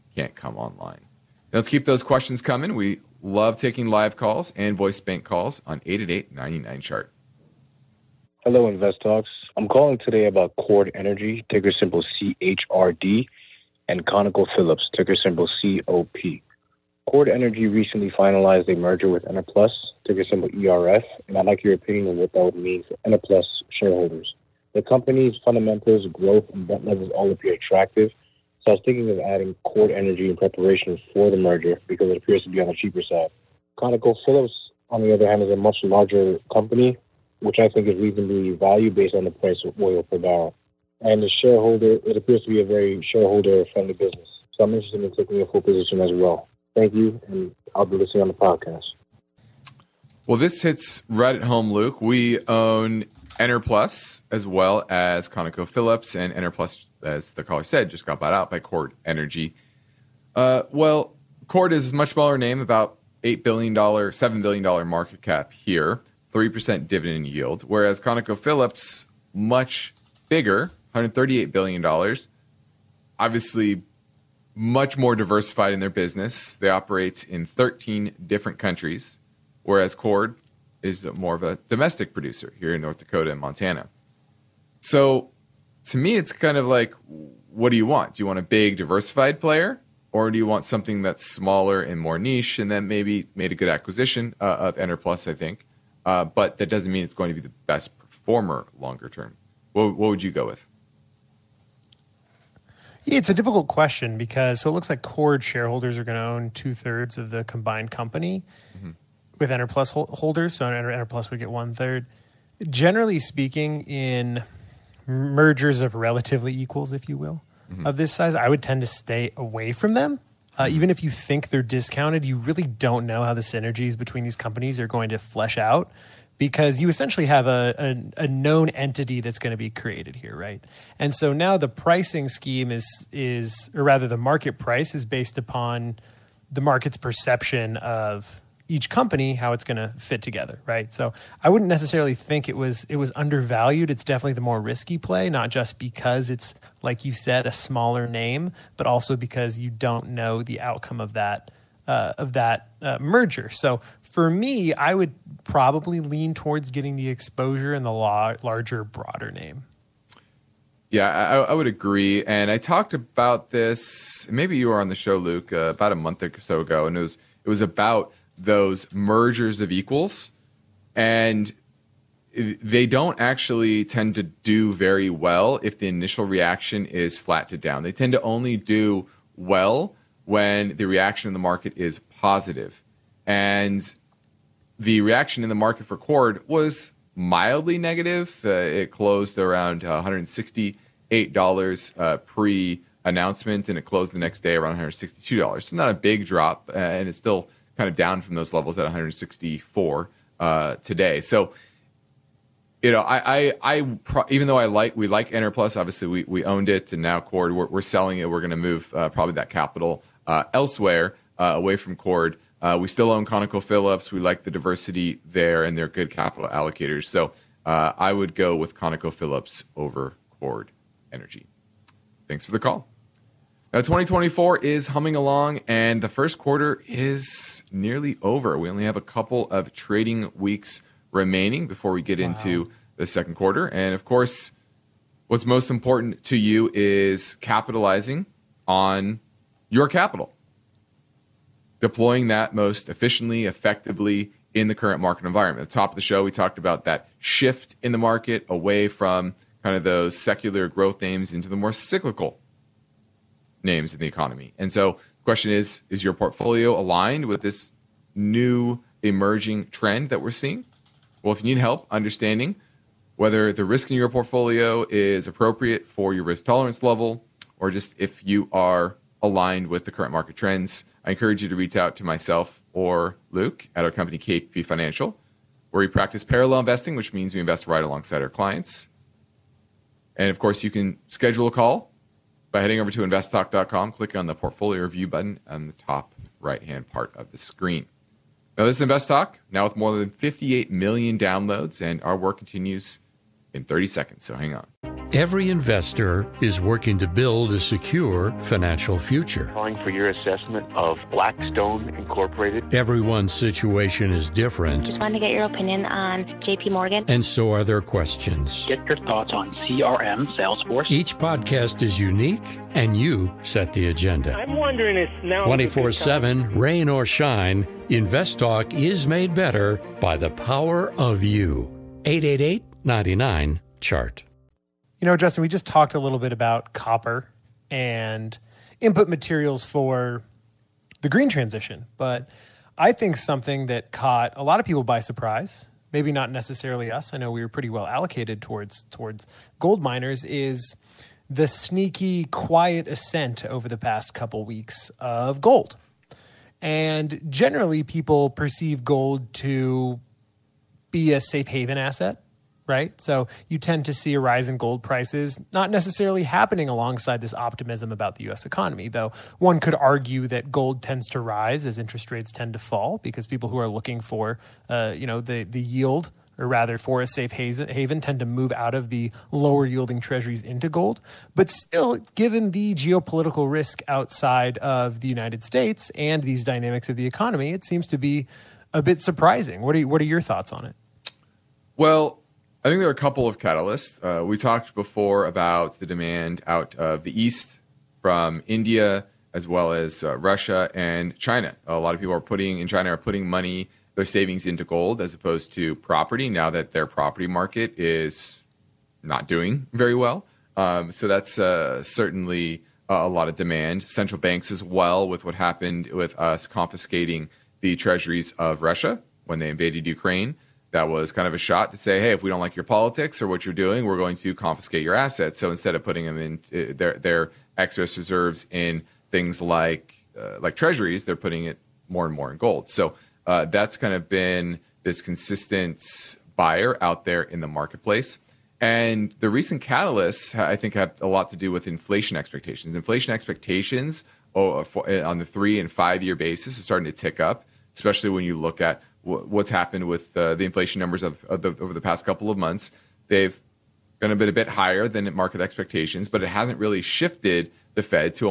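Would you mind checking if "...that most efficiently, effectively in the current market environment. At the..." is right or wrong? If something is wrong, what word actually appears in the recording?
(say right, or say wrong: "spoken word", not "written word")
right.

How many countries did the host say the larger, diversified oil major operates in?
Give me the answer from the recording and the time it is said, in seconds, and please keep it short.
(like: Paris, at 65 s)
13, at 77 s.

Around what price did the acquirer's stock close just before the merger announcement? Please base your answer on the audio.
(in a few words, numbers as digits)
$168.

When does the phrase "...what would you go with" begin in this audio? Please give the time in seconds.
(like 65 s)
99 s.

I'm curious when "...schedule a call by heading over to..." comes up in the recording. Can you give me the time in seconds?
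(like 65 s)
281 s.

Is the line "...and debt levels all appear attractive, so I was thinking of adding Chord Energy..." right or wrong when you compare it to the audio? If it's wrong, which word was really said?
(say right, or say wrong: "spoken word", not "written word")
right.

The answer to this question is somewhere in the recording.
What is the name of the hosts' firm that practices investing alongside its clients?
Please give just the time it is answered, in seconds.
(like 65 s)
274 s.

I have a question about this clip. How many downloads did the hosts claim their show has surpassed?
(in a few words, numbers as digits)
58 million.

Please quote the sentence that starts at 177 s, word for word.
They tend to only do well when the reaction in the market is positive.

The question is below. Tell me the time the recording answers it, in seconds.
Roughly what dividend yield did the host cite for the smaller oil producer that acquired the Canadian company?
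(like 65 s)
66 s.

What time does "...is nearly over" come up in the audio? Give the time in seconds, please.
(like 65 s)
226 s.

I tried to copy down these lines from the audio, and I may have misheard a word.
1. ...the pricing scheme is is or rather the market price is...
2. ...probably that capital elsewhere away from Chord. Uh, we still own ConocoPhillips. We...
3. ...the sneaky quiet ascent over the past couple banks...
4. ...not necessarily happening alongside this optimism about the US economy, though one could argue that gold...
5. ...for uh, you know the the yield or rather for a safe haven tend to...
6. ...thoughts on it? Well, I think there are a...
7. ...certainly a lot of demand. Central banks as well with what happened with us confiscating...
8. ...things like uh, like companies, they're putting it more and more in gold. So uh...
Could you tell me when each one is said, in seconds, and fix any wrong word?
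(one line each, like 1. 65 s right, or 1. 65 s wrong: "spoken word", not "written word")
1. 131 s right
2. 209 s right
3. 341 s wrong: "weeks", not "banks"
4. 355 s right
5. 363 s right
6. 380 s right
7. 401 s right
8. 419 s wrong: "treasuries", not "companies".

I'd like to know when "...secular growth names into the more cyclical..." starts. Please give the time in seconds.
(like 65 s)
250 s.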